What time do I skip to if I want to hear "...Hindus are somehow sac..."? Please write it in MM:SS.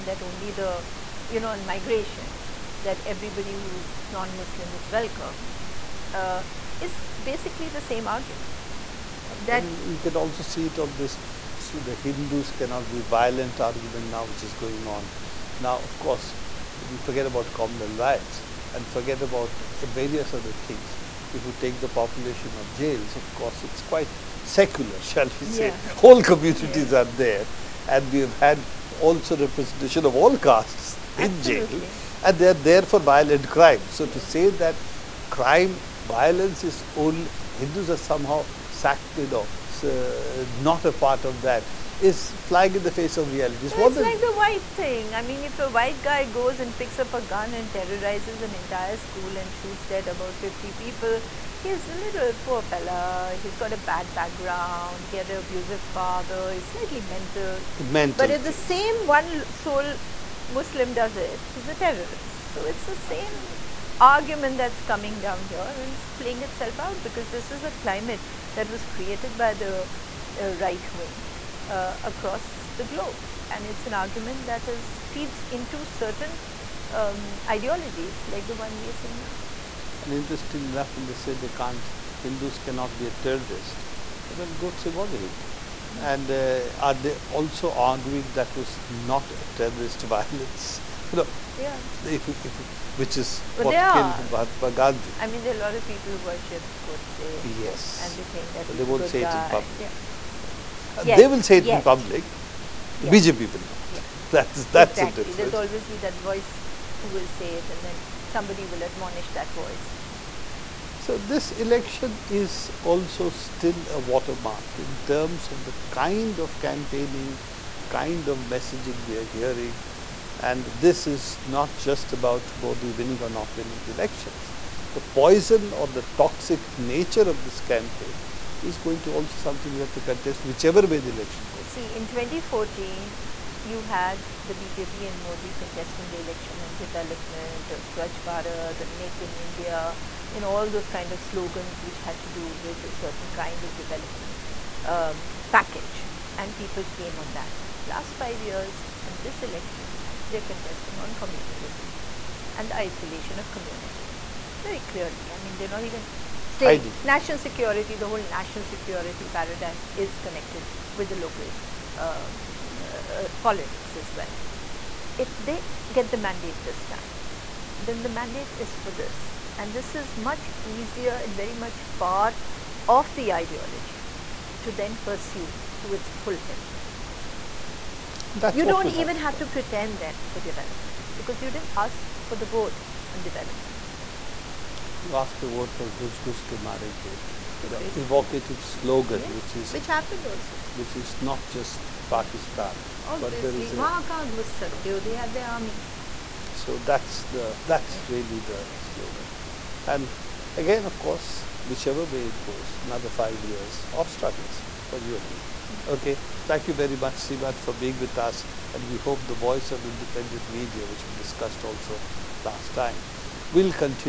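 00:37.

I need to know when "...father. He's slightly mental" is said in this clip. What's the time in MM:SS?
00:55.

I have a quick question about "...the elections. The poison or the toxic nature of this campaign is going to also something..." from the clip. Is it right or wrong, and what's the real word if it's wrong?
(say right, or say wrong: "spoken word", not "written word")
right.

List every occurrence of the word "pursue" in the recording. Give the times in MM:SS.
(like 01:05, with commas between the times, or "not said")
02:54.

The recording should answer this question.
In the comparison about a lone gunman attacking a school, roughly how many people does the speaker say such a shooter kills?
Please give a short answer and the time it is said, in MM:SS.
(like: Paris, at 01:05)
50, at 00:50.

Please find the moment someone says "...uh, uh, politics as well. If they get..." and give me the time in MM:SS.
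02:42.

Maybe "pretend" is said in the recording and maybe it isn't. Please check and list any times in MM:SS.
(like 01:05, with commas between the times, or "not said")
02:59.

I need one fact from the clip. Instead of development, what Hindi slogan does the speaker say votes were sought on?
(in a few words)
Ghus Ke Marenge.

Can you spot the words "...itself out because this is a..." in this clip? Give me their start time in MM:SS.
01:06.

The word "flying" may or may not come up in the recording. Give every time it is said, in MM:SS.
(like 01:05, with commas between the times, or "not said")
00:42.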